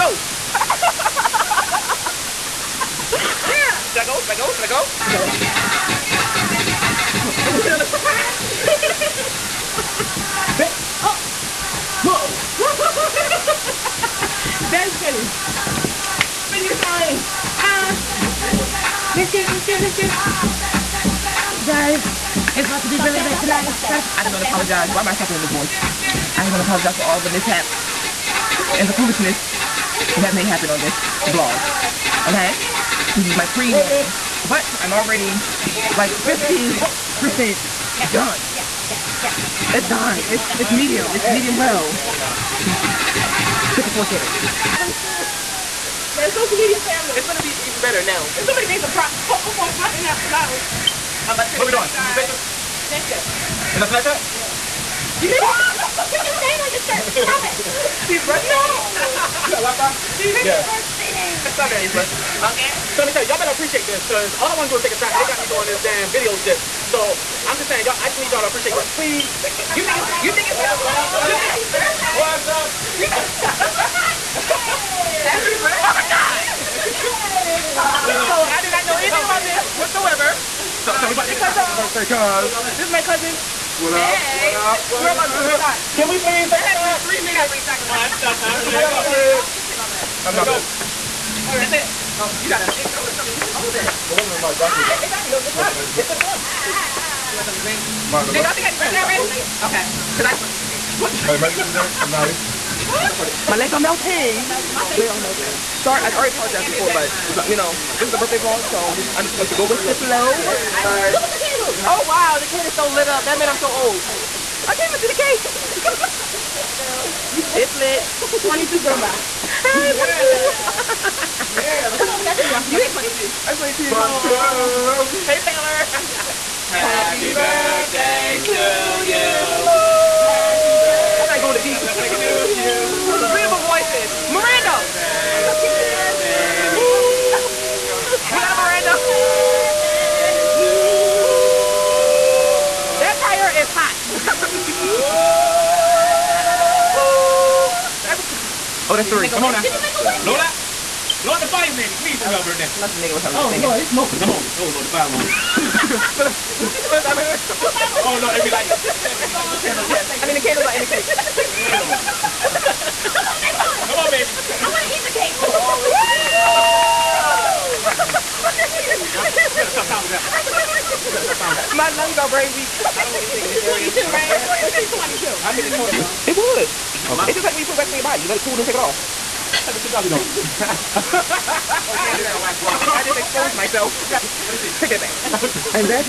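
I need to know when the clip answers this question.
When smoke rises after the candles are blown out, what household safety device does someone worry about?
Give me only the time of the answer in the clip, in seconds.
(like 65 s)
154 s.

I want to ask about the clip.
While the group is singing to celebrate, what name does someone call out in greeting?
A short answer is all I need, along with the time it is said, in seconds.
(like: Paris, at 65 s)
Taylor, at 125 s.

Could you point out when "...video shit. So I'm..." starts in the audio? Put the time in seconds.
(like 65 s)
66 s.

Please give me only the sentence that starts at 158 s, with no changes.
The candles be like, what's candles?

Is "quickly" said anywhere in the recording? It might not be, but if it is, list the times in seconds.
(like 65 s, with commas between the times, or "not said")
not said.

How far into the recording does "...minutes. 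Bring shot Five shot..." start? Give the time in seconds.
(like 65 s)
87 s.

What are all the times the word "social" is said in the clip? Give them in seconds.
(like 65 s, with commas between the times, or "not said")
46 s.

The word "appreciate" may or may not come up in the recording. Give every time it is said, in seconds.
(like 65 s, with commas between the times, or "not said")
63 s, 68 s.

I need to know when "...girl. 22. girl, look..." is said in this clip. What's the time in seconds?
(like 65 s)
119 s.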